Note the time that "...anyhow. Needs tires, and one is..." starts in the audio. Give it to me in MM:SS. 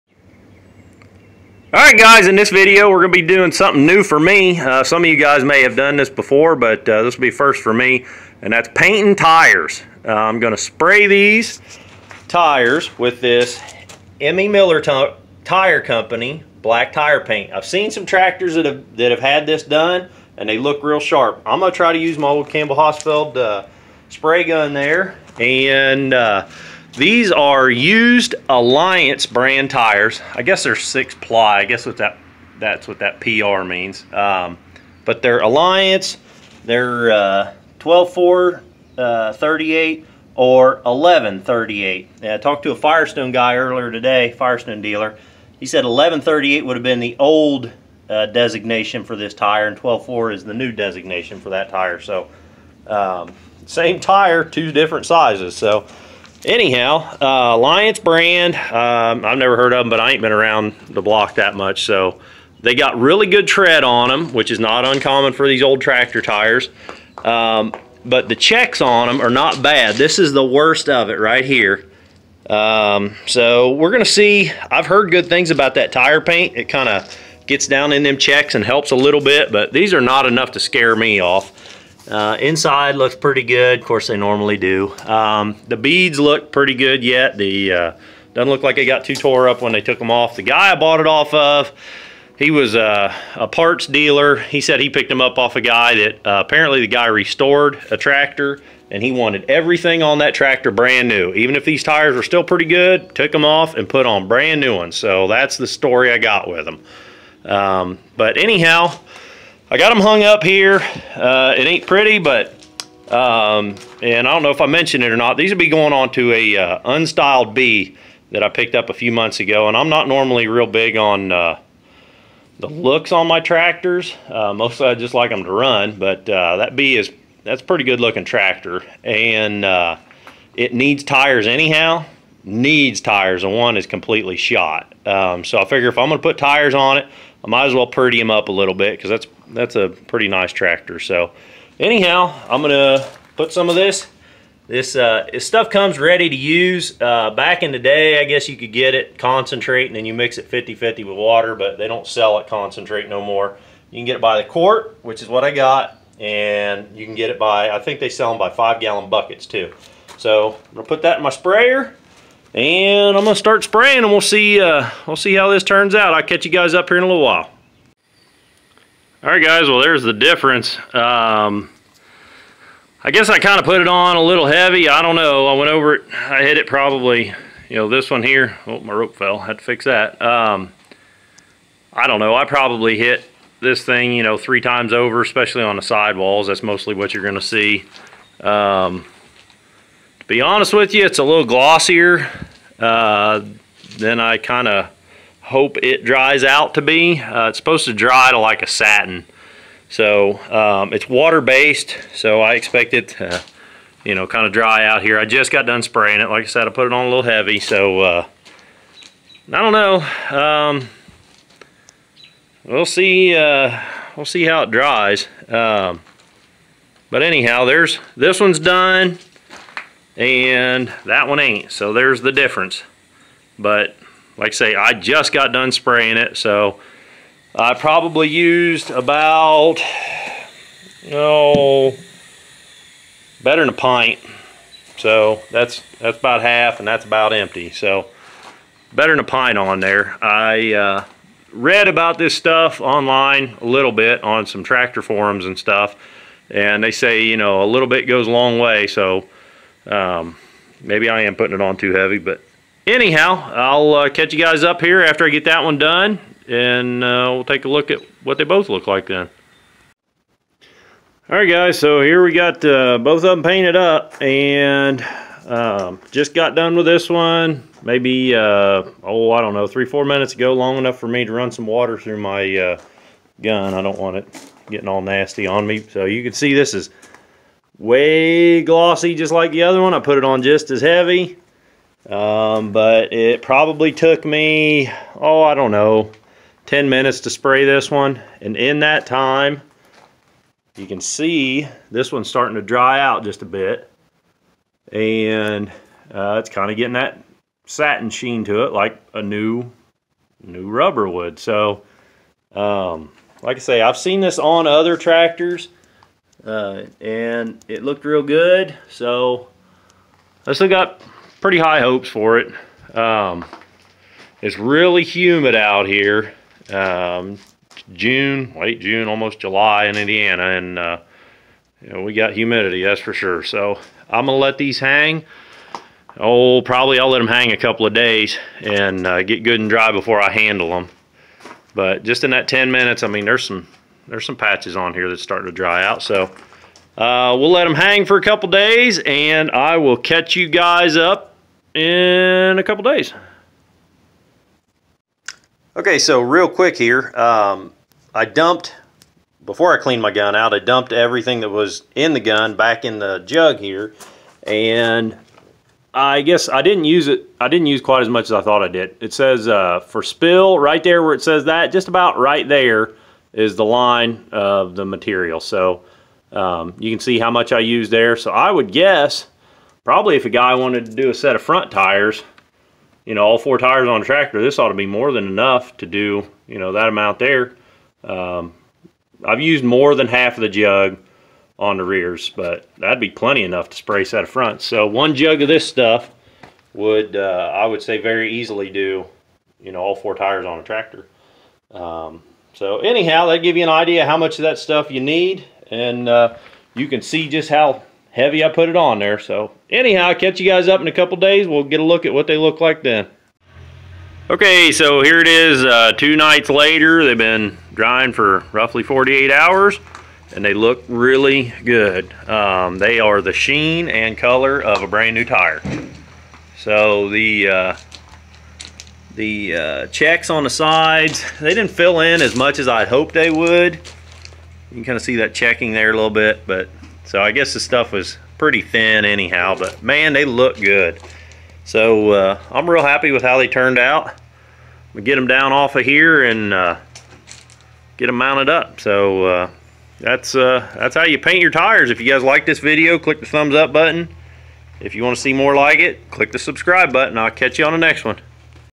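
02:11.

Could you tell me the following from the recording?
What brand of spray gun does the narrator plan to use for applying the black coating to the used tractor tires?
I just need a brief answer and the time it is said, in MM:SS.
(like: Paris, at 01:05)
Campbell Hausfeld, at 00:22.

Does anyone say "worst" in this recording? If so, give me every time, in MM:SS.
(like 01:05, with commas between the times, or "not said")
01:10.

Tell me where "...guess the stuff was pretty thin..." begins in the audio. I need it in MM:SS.
07:07.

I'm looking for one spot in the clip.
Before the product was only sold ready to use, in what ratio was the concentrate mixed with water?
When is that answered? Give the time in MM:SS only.
02:30.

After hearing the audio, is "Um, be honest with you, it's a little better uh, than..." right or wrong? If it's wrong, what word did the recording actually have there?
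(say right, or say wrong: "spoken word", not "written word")
wrong: "glossier", not "better".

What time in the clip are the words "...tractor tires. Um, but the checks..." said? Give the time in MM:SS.
01:05.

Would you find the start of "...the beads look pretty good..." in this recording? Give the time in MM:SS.
01:25.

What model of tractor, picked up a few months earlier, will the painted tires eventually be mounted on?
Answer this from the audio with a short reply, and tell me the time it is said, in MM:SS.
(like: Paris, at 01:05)
unstyled B, at 01:56.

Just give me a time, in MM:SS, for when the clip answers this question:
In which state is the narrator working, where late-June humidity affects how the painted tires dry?
05:19.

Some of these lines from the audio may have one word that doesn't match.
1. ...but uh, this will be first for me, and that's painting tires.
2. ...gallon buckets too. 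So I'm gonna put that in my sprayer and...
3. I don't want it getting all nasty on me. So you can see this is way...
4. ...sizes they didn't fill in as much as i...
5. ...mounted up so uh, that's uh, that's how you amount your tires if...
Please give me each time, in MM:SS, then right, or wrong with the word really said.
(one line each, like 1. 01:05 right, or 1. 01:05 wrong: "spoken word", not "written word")
1. 00:06 right
2. 02:38 right
3. 04:33 right
4. 07:00 wrong: "sides", not "sizes"
5. 07:18 wrong: "paint", not "amount".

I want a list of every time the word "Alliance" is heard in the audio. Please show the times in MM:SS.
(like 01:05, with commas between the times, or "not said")
00:28, 00:35, 00:57.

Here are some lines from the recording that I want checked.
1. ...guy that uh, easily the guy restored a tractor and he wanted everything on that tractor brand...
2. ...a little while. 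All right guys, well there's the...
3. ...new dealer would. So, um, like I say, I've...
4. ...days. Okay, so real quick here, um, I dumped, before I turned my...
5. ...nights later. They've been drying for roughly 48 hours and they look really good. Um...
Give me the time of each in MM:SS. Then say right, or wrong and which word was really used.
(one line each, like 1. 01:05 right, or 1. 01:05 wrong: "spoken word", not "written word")
1. 01:35 wrong: "apparently", not "easily"
2. 02:47 right
3. 05:00 wrong: "rubber", not "dealer"
4. 05:42 wrong: "cleaned", not "turned"
5. 06:46 right.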